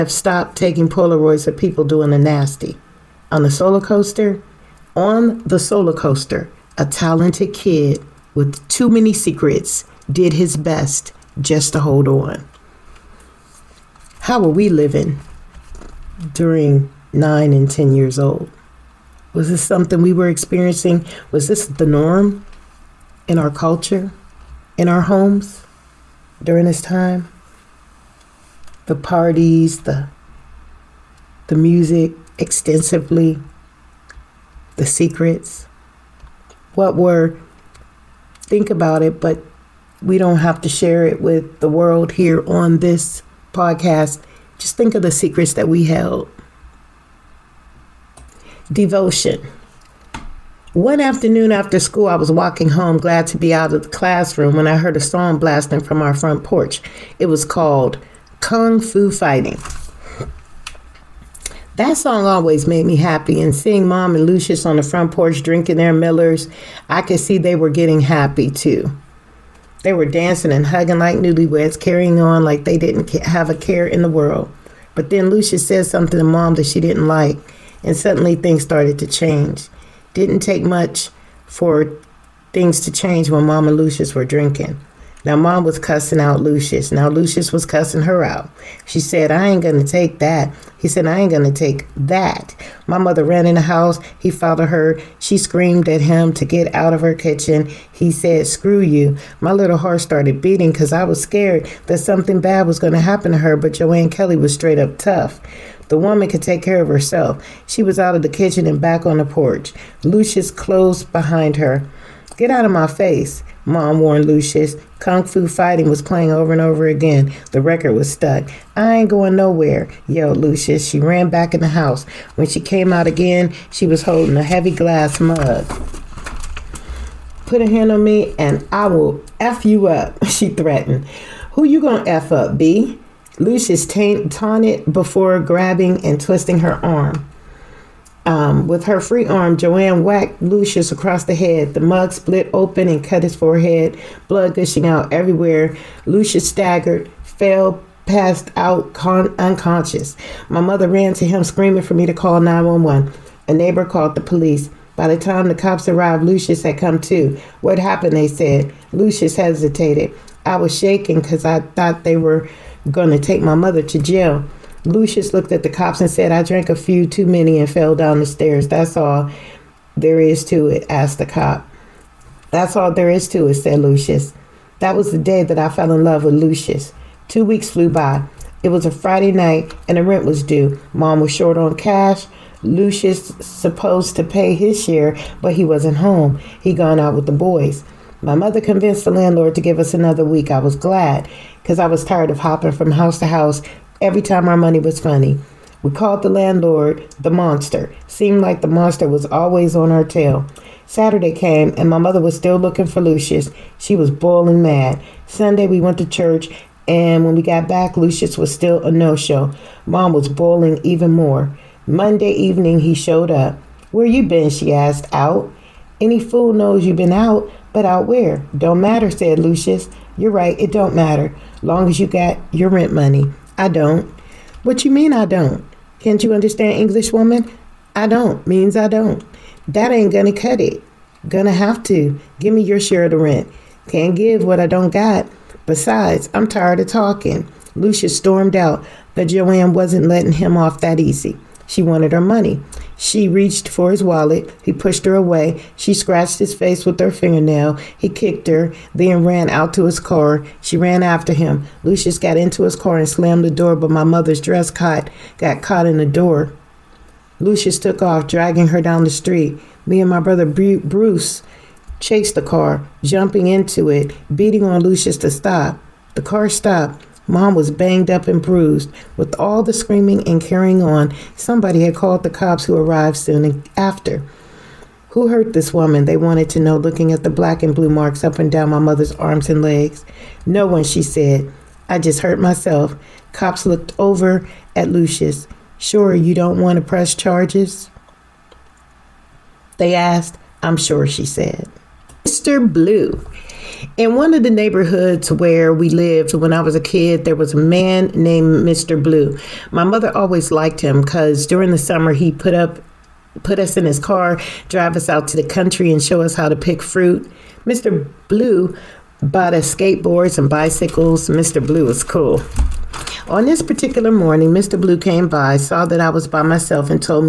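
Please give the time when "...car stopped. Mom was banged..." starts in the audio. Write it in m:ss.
4:26.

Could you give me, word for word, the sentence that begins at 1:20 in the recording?
Didn't take much for things to change when mom and Lucius were drinking.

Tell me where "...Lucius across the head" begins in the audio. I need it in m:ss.
2:20.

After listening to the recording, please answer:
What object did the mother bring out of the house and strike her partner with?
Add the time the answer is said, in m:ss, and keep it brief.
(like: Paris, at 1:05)
A heavy glass mug, at 2:04.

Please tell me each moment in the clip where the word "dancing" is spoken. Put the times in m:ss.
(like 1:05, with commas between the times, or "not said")
1:10.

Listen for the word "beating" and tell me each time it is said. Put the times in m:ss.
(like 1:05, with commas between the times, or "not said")
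1:40, 4:24.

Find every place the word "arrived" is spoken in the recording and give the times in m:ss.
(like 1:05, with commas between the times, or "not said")
2:35, 4:32.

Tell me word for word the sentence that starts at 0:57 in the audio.
It was called Kung Fu Fighting.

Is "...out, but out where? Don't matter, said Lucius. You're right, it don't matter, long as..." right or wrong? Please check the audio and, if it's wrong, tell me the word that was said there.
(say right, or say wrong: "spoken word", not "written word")
right.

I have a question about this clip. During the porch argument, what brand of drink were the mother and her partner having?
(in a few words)
Millers.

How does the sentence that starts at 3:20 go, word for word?
Saturday came, and my mother was still looking for Lucius.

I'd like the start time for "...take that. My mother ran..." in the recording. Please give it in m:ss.
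1:31.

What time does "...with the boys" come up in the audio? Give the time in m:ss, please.
3:07.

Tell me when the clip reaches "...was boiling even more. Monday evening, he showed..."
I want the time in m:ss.
3:30.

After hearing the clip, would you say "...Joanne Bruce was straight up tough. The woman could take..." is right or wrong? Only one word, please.
wrong.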